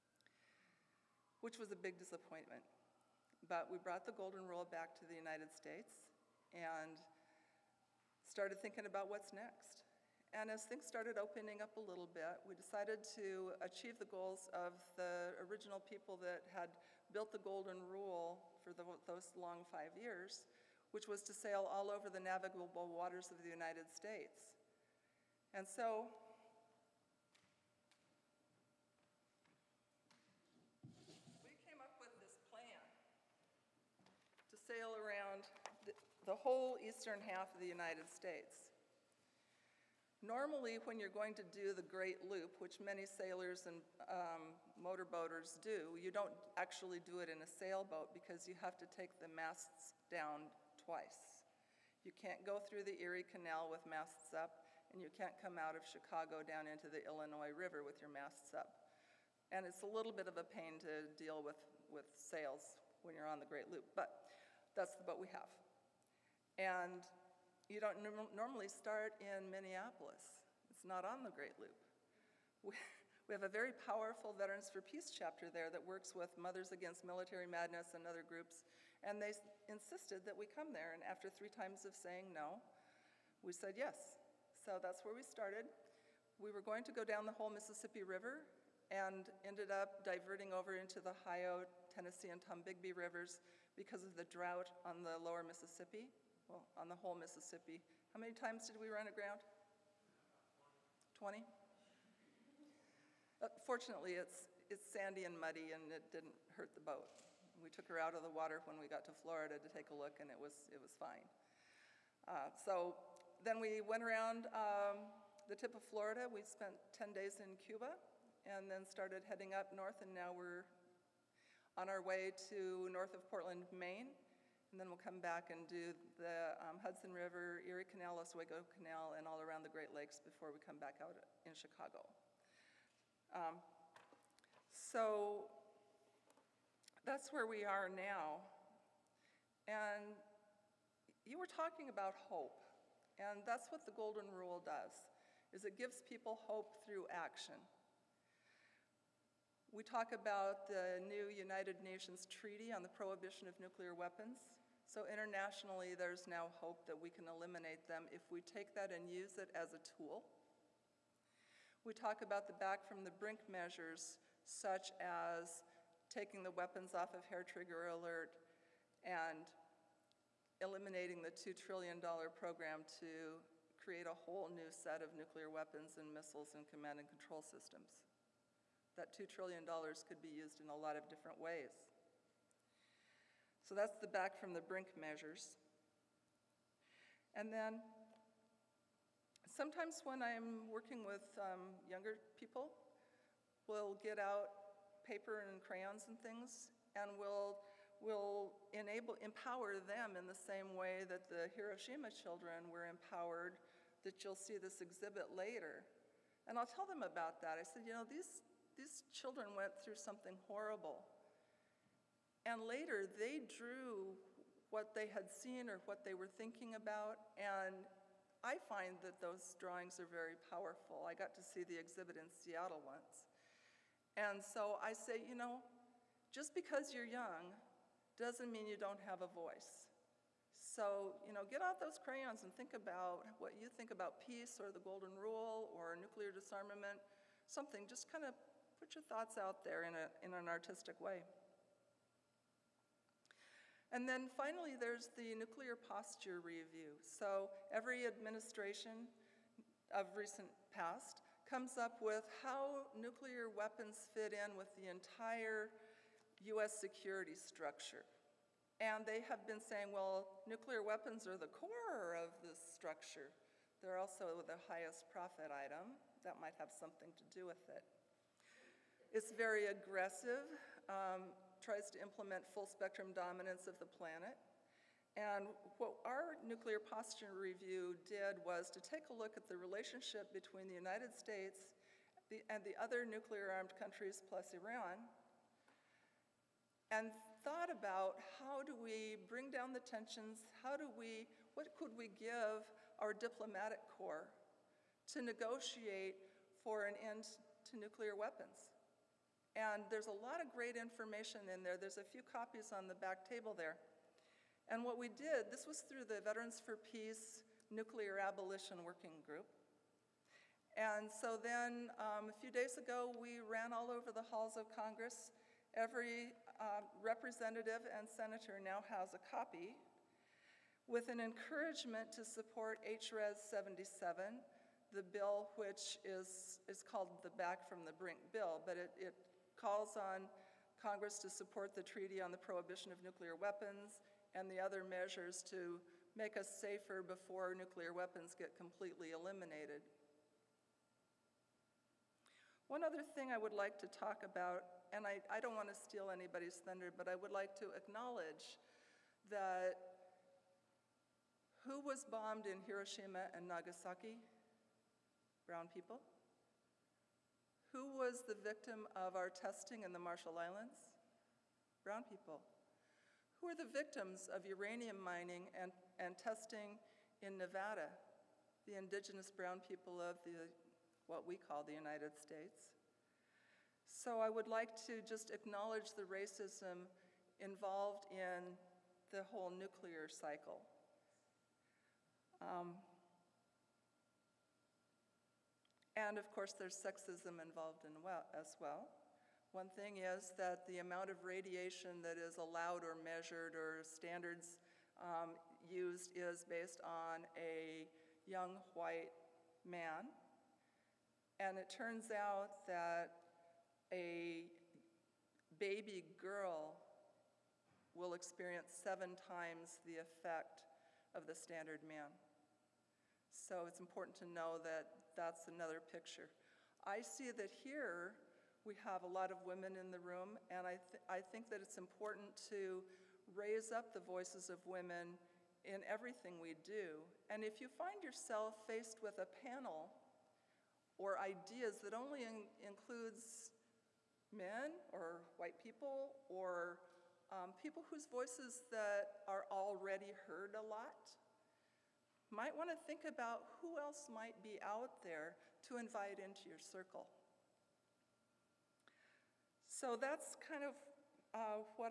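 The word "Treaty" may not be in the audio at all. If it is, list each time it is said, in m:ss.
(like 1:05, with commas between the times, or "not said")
2:32, 5:31.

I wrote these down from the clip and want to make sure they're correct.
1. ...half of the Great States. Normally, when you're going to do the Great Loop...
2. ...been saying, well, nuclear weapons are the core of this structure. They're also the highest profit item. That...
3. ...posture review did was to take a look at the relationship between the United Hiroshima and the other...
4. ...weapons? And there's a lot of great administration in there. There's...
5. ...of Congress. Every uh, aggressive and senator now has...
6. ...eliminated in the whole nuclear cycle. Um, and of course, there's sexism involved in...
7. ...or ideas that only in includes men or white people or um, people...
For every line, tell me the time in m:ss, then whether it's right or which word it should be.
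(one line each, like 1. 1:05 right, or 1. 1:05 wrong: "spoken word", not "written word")
1. 0:37 wrong: "United", not "Great"
2. 4:19 right
3. 4:36 wrong: "States", not "Hiroshima"
4. 4:58 wrong: "information", not "administration"
5. 5:14 wrong: "representative", not "aggressive"
6. 6:17 wrong: "involved", not "eliminated"
7. 7:10 right.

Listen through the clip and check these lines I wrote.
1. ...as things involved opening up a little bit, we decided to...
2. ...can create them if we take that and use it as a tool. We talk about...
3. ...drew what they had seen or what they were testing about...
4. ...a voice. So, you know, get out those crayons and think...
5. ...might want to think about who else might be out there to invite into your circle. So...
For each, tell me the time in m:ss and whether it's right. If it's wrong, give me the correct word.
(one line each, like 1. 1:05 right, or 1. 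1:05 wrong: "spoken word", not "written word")
1. 0:10 wrong: "started", not "involved"
2. 2:37 wrong: "eliminate", not "create"
3. 3:33 wrong: "thinking", not "testing"
4. 3:49 right
5. 7:22 right.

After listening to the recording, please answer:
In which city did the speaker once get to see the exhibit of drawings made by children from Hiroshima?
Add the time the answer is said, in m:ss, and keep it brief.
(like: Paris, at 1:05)
Seattle, at 3:42.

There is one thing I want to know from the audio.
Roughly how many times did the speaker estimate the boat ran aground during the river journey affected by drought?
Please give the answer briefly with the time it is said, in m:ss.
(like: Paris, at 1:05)
20, at 1:41.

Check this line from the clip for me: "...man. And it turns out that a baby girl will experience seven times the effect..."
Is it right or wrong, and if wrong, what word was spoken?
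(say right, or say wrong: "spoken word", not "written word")
right.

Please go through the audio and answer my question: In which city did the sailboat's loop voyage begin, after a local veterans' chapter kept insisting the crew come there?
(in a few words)
Minneapolis.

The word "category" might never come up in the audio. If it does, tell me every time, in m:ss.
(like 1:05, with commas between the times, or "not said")
not said.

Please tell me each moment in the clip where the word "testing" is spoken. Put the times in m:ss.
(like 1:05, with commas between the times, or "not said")
5:59, 6:06.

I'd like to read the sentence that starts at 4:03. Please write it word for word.
And then finally, there's the nuclear posture review.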